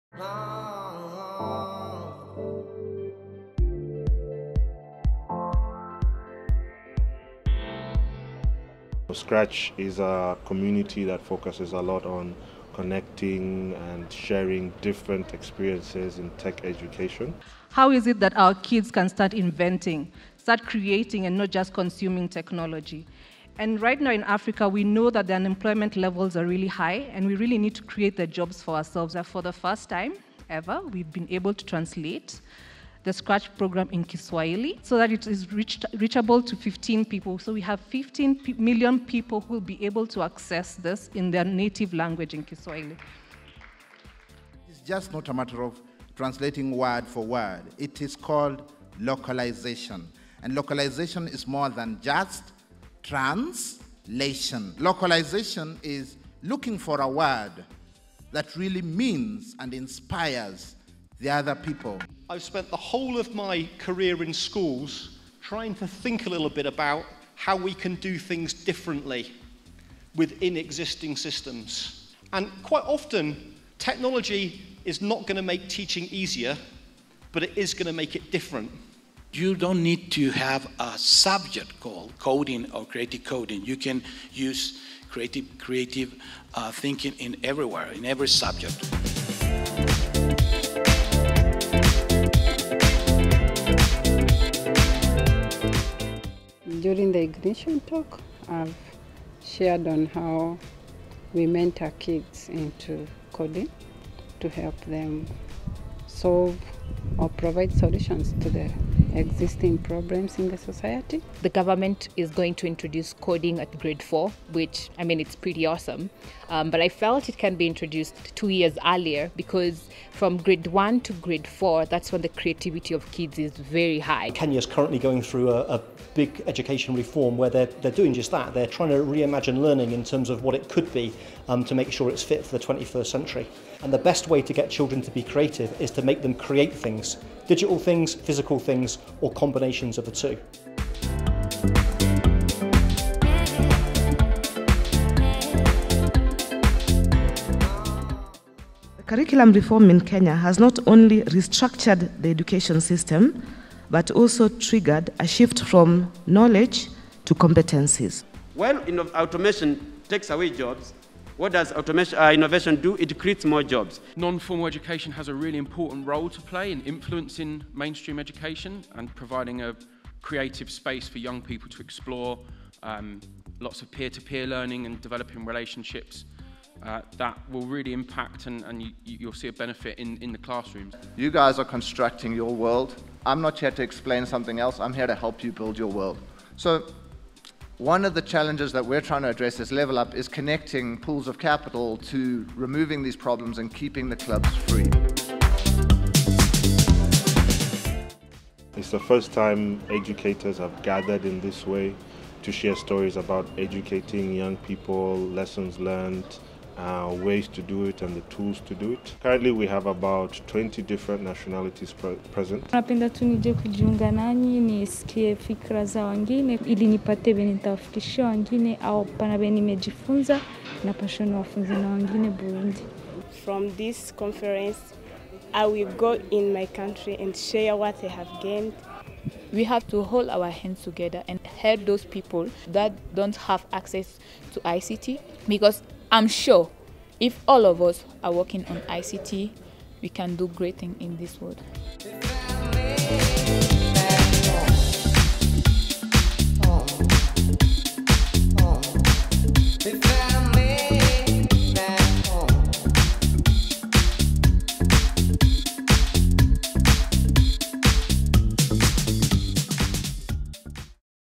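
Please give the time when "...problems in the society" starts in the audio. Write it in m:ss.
1:49.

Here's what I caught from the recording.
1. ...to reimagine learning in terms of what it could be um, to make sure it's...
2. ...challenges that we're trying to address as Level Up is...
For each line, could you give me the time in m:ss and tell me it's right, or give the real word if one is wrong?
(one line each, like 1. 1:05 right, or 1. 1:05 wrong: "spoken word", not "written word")
1. 2:08 right
2. 3:08 right.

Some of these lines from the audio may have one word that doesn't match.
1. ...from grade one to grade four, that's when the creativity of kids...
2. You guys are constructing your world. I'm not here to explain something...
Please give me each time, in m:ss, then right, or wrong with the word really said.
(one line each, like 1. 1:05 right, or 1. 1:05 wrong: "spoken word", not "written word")
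1. 2:00 right
2. 3:01 right.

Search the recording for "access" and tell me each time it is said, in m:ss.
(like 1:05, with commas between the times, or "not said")
0:40, 3:53.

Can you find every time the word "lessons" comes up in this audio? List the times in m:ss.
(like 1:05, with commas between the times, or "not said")
3:25.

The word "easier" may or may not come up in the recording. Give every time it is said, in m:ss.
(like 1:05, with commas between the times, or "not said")
1:16.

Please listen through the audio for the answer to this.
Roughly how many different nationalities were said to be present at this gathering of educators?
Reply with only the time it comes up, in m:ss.
3:30.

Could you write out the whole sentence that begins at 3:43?
From this conference I will go in my country and share what I have gained.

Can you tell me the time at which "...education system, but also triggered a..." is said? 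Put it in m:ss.
2:32.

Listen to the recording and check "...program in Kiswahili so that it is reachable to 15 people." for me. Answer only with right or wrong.
right.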